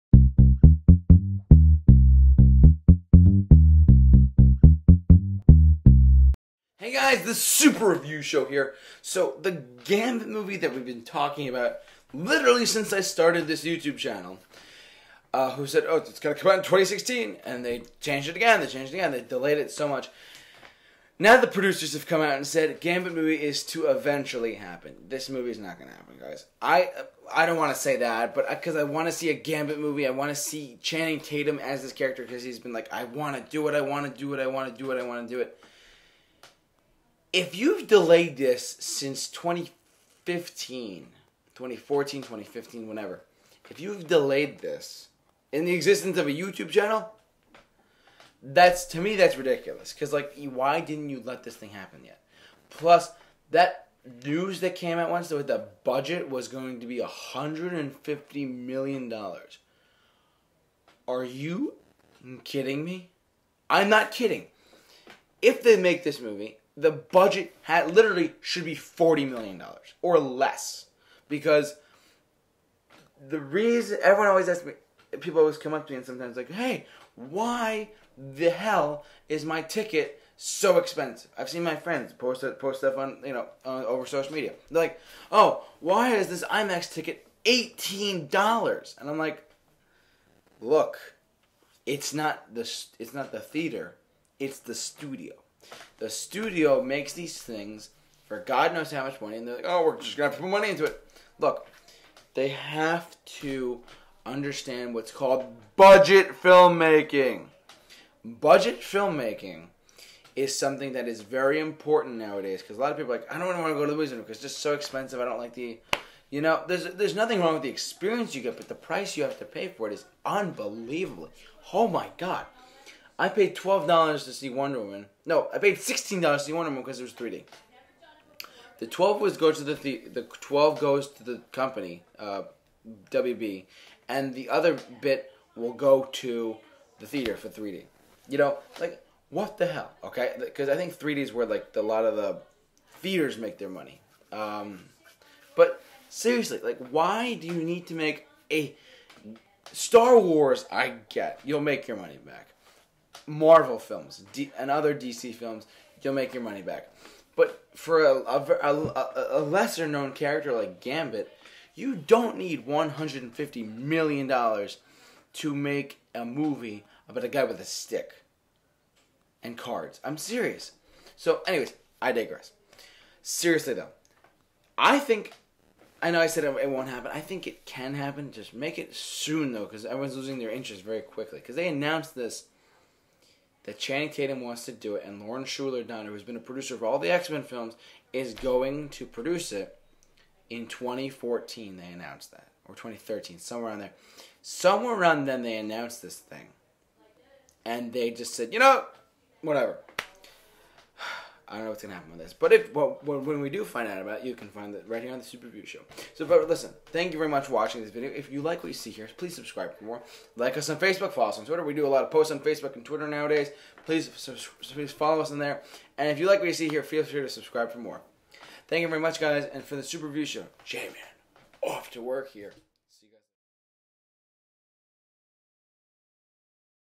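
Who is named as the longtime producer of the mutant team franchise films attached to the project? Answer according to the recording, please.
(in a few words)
Lauren Shuler Donner.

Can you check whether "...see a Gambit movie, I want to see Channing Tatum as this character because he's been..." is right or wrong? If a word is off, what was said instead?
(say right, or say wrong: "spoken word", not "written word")
right.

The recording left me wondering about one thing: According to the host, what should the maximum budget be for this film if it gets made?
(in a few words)
$40 million.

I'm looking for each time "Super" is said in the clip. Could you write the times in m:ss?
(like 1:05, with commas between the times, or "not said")
0:07, 3:25, 3:39.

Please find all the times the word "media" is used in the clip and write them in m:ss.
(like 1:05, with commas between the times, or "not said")
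1:24.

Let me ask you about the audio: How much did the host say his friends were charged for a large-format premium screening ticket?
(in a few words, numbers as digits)
$18.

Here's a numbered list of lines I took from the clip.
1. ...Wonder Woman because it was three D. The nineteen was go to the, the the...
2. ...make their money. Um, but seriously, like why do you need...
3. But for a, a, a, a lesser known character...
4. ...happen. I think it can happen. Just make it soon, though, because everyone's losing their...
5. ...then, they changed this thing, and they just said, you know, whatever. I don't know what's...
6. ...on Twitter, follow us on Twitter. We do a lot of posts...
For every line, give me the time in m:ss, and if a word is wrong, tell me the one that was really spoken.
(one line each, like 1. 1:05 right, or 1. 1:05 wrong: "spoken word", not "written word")
1. 2:06 wrong: "twelve", not "nineteen"
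2. 2:23 right
3. 2:37 right
4. 2:56 right
5. 3:15 wrong: "announced", not "changed"
6. 3:30 wrong: "Facebook", not "Twitter".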